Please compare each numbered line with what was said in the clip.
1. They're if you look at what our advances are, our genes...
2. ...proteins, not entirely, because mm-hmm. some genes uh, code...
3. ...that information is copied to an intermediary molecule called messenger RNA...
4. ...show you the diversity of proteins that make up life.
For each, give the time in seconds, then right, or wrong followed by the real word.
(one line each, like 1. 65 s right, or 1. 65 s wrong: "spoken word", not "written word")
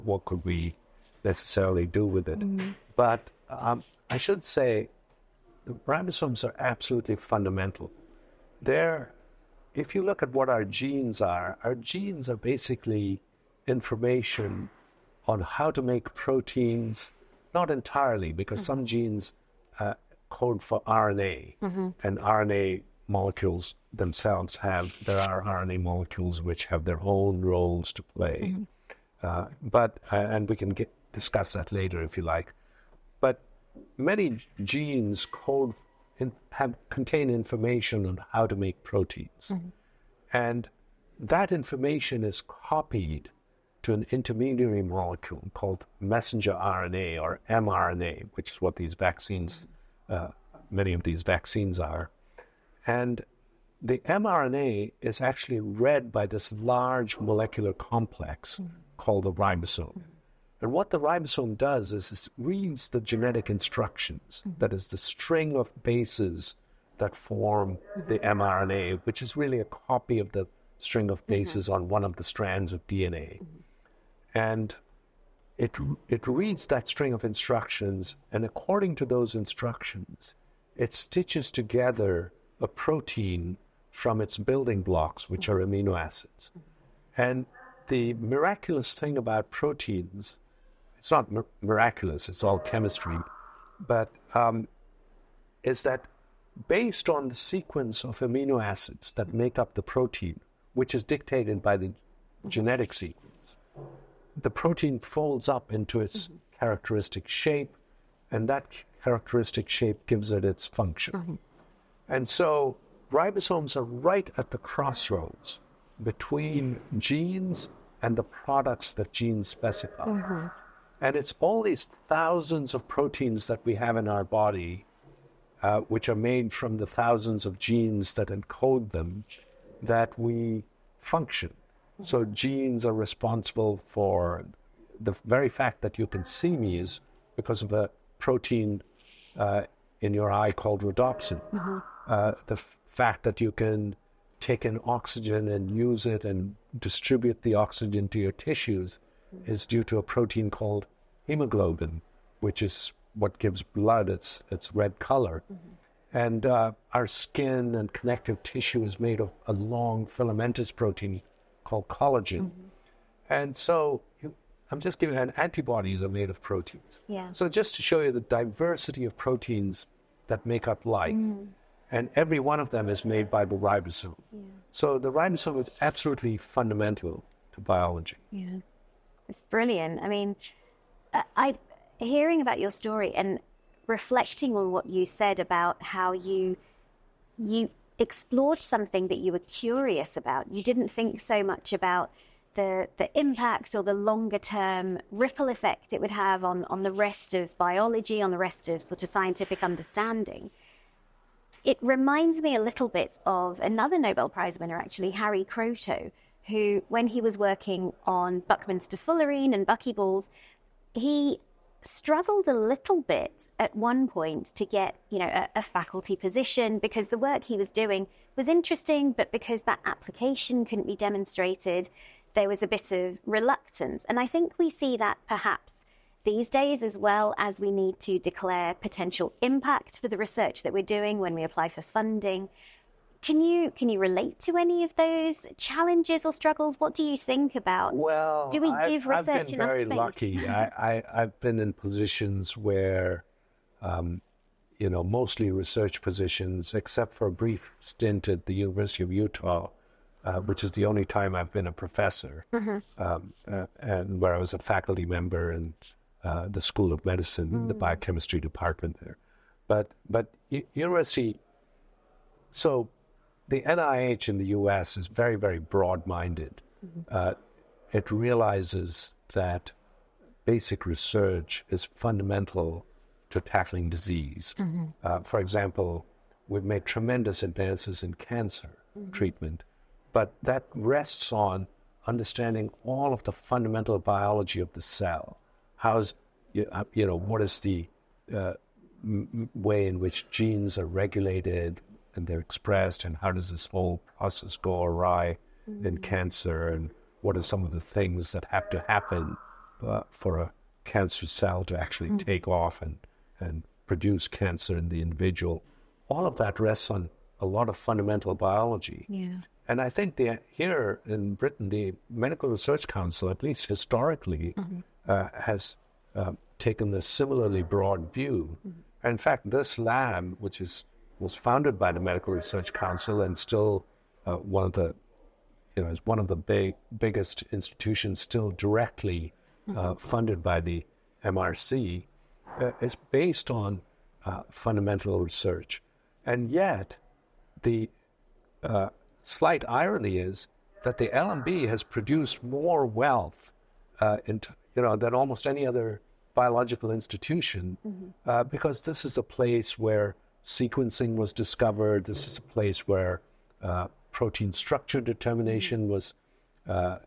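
1. 8 s wrong: "genes", not "advances"
2. 16 s right
3. 41 s right
4. 167 s right.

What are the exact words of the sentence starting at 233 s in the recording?
Can you can you relate to any of those challenges or struggles?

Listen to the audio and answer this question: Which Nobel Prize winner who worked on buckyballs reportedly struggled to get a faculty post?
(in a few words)
Harry Kroto.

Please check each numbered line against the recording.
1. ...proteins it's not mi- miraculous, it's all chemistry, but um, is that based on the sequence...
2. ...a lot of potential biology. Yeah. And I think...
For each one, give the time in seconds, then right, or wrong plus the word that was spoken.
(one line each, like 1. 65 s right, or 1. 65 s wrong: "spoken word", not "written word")
1. 89 s right
2. 307 s wrong: "fundamental", not "potential".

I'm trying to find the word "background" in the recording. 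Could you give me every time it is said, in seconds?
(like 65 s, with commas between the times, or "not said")
not said.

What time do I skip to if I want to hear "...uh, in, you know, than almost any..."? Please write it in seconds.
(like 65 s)
344 s.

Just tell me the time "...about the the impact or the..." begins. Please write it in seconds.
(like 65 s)
191 s.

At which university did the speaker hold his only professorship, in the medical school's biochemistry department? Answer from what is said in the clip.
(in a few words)
University of Utah.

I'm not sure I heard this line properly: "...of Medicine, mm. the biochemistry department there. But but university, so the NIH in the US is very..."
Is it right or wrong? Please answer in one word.
right.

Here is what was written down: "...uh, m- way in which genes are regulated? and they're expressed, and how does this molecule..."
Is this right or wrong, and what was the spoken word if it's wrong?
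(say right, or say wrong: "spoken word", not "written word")
wrong: "whole", not "molecule".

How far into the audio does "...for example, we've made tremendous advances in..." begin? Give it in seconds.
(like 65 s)
275 s.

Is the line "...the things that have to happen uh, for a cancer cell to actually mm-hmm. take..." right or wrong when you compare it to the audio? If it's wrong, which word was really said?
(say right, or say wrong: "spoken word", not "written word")
right.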